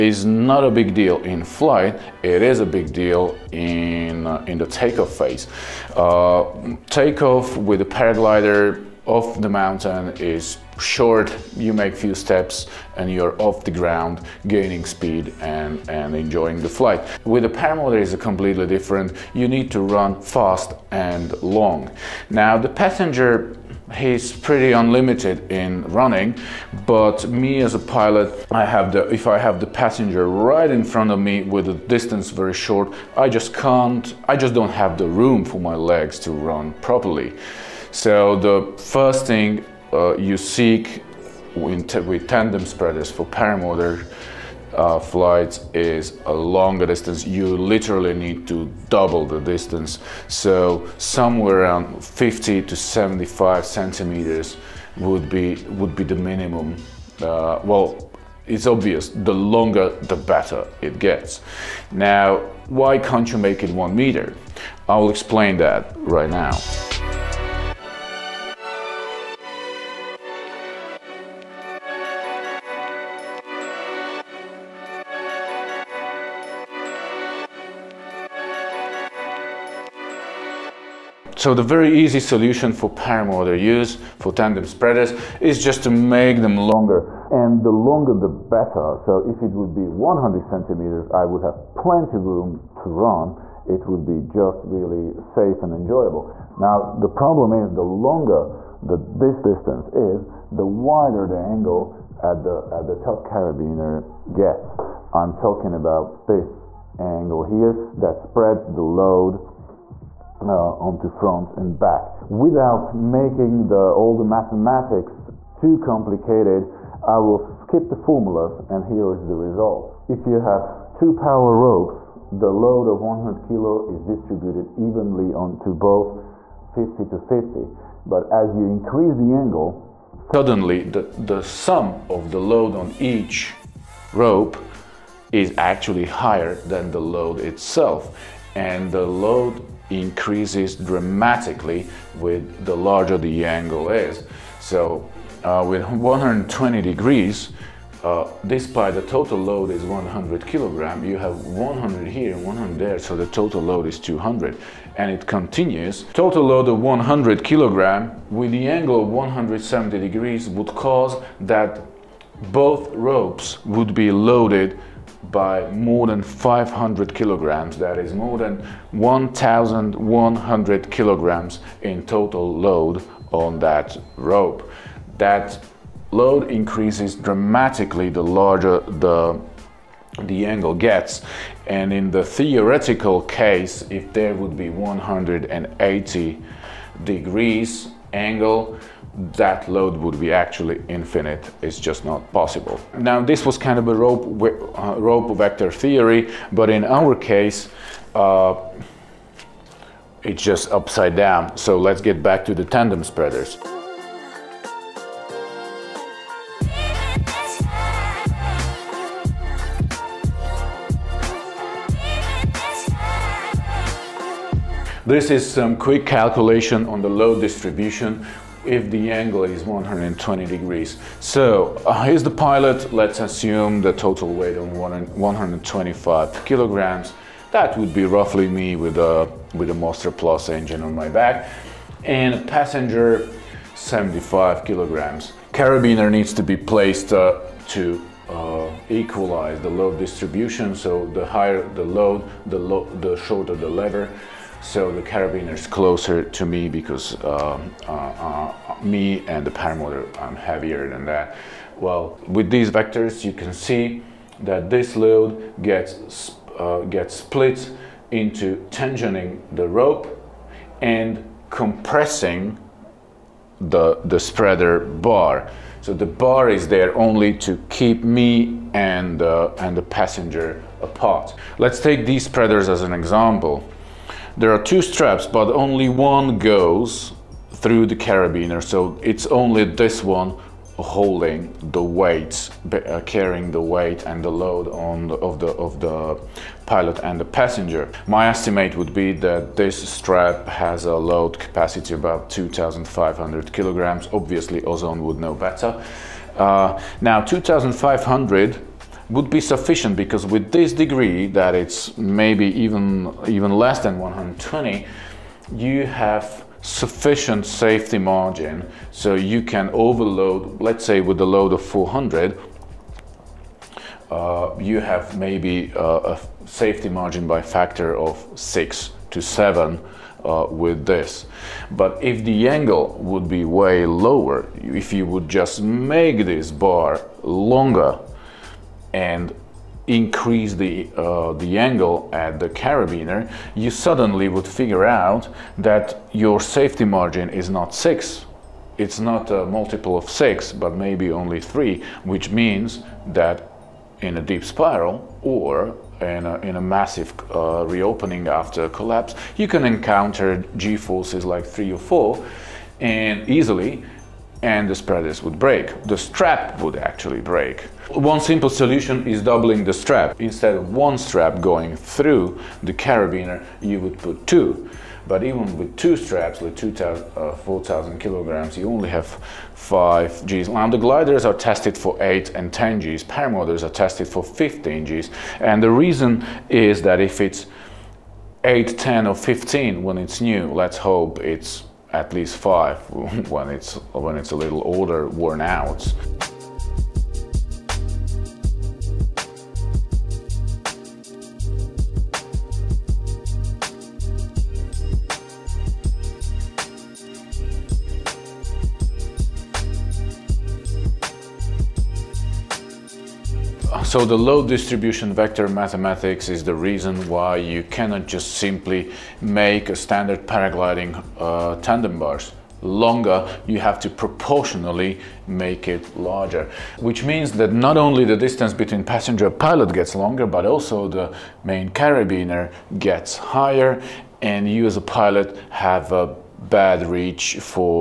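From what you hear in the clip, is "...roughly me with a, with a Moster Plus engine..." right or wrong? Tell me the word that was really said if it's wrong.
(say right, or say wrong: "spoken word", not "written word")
right.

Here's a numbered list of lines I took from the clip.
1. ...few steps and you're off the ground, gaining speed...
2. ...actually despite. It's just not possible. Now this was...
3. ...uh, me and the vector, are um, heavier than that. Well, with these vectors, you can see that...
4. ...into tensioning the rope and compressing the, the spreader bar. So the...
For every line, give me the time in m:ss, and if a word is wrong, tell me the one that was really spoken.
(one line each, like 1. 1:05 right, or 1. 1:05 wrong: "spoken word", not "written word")
1. 0:11 right
2. 3:10 wrong: "infinite", not "despite"
3. 4:07 wrong: "paramotor", not "vector"
4. 4:18 right.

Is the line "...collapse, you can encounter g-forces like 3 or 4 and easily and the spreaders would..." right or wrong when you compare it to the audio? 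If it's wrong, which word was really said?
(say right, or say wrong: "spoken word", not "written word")
right.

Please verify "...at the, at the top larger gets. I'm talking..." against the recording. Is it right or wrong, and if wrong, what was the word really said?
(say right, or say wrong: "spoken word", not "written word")
wrong: "carabiner", not "larger".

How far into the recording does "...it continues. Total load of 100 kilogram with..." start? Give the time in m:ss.
2:35.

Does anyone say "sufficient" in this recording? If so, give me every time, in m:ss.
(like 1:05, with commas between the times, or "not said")
4:59, 5:06.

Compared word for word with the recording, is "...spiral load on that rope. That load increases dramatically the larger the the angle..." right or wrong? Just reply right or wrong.
wrong.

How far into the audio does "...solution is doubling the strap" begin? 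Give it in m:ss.
5:58.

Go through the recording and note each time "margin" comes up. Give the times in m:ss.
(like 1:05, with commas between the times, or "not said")
5:07, 5:16, 5:36.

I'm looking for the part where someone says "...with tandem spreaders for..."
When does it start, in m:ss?
0:41.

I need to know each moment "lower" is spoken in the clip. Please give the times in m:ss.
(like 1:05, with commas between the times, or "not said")
5:23.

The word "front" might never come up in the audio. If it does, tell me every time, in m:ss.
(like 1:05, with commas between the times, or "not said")
0:30, 1:51.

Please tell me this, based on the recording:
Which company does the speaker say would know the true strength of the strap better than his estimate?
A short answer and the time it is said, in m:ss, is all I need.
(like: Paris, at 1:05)
Ozone, at 4:54.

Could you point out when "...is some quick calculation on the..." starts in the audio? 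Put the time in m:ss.
3:35.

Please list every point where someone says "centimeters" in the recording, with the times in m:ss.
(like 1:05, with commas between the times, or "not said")
0:53, 1:30.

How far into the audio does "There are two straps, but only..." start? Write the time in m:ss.
4:34.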